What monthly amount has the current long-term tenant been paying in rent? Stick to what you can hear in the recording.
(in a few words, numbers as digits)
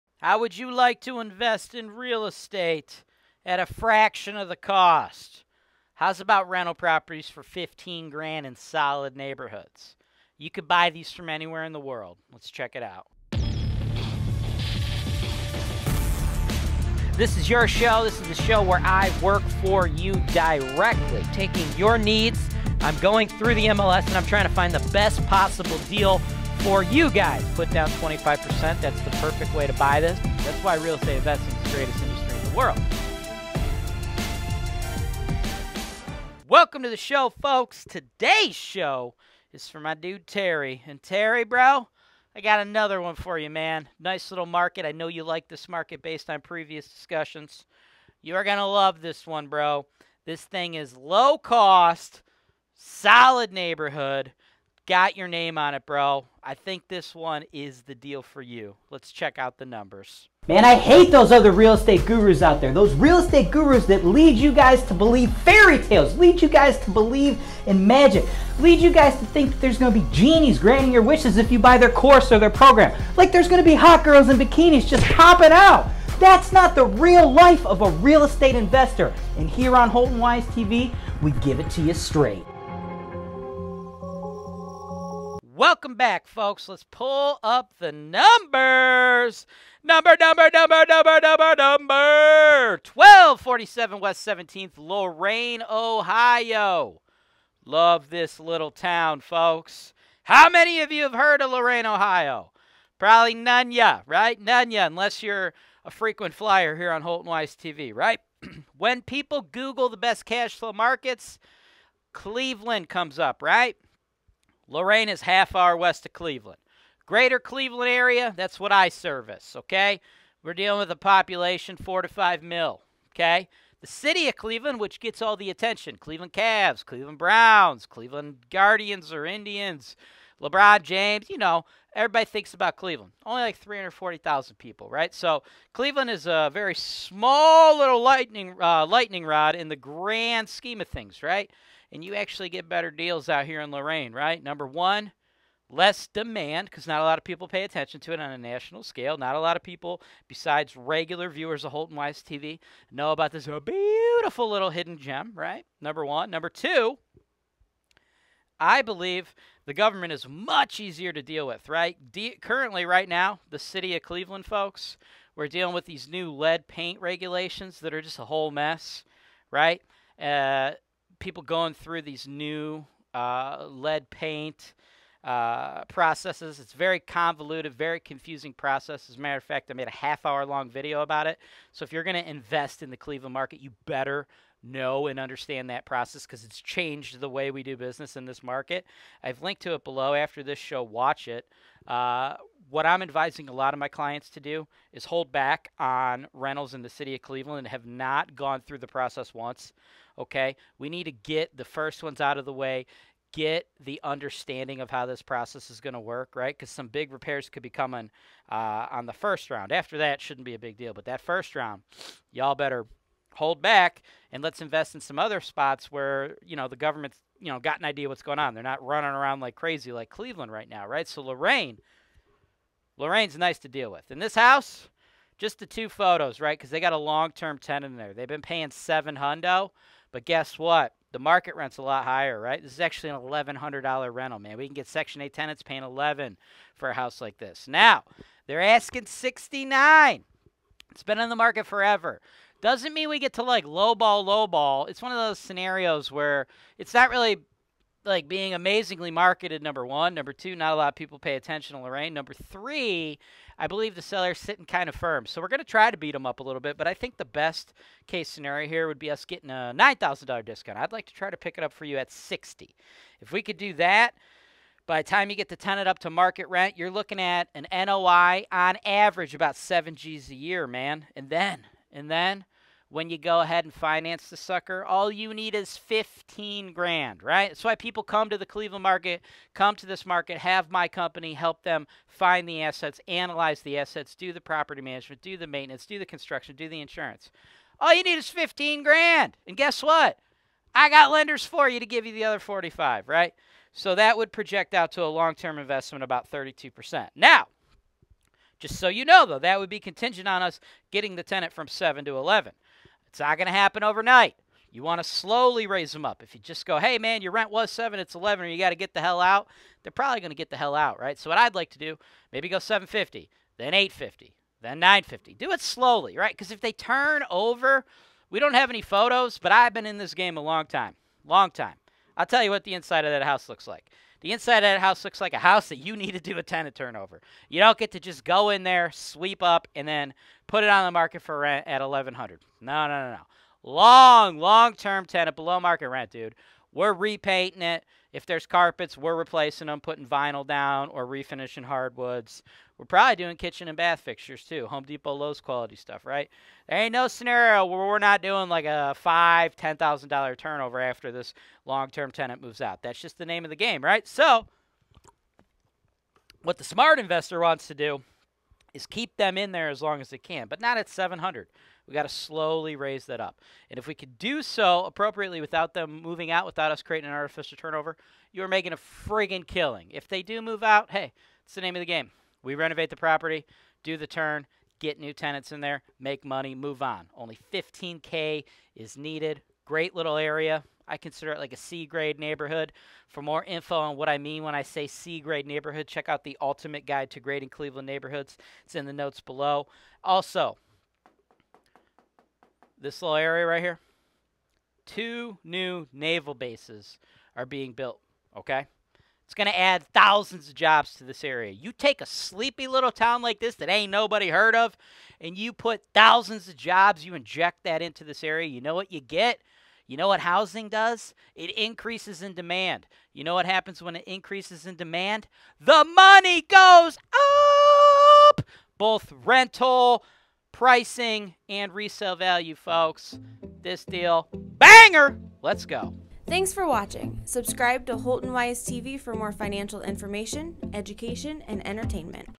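$700.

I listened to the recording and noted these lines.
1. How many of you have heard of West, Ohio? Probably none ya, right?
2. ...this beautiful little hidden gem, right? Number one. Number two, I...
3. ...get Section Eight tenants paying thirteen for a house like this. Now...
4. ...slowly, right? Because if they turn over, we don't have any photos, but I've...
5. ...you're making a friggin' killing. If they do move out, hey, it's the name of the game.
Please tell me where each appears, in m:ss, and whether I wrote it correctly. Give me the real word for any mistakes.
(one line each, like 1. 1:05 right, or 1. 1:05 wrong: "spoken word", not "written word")
1. 1:40 wrong: "Lorain", not "West"
2. 2:33 right
3. 3:54 wrong: "eleven", not "thirteen"
4. 5:15 right
5. 6:08 right.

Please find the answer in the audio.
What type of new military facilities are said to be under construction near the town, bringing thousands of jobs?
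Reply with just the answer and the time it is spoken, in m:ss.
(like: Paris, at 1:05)
naval bases, at 6:35.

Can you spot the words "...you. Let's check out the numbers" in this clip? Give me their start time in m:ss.
0:58.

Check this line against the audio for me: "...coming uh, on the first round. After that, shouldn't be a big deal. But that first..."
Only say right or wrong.
right.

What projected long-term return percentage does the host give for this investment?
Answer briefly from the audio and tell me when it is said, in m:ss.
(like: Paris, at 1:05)
32%, at 4:56.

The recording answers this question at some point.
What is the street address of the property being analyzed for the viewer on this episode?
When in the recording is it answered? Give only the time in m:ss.
1:32.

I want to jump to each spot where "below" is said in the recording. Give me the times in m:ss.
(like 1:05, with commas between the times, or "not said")
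3:09, 5:35, 6:29.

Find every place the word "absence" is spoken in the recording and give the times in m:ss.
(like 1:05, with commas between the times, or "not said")
not said.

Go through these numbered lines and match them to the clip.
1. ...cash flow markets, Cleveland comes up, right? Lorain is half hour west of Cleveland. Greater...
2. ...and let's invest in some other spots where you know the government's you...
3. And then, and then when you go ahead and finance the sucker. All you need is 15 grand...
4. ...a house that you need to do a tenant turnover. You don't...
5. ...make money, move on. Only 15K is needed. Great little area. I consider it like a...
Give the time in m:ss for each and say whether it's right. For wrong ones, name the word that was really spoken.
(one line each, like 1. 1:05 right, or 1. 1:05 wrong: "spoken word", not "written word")
1. 1:50 right
2. 3:34 right
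3. 4:31 right
4. 5:25 right
5. 6:15 right.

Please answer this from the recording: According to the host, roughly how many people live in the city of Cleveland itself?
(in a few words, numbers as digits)
340,000.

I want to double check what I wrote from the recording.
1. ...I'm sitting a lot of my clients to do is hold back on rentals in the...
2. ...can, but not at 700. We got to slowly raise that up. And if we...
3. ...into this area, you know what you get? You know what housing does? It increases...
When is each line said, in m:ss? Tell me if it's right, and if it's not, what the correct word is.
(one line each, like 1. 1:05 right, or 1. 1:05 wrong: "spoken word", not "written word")
1. 3:12 wrong: "advising", not "sitting"
2. 6:00 right
3. 6:47 right.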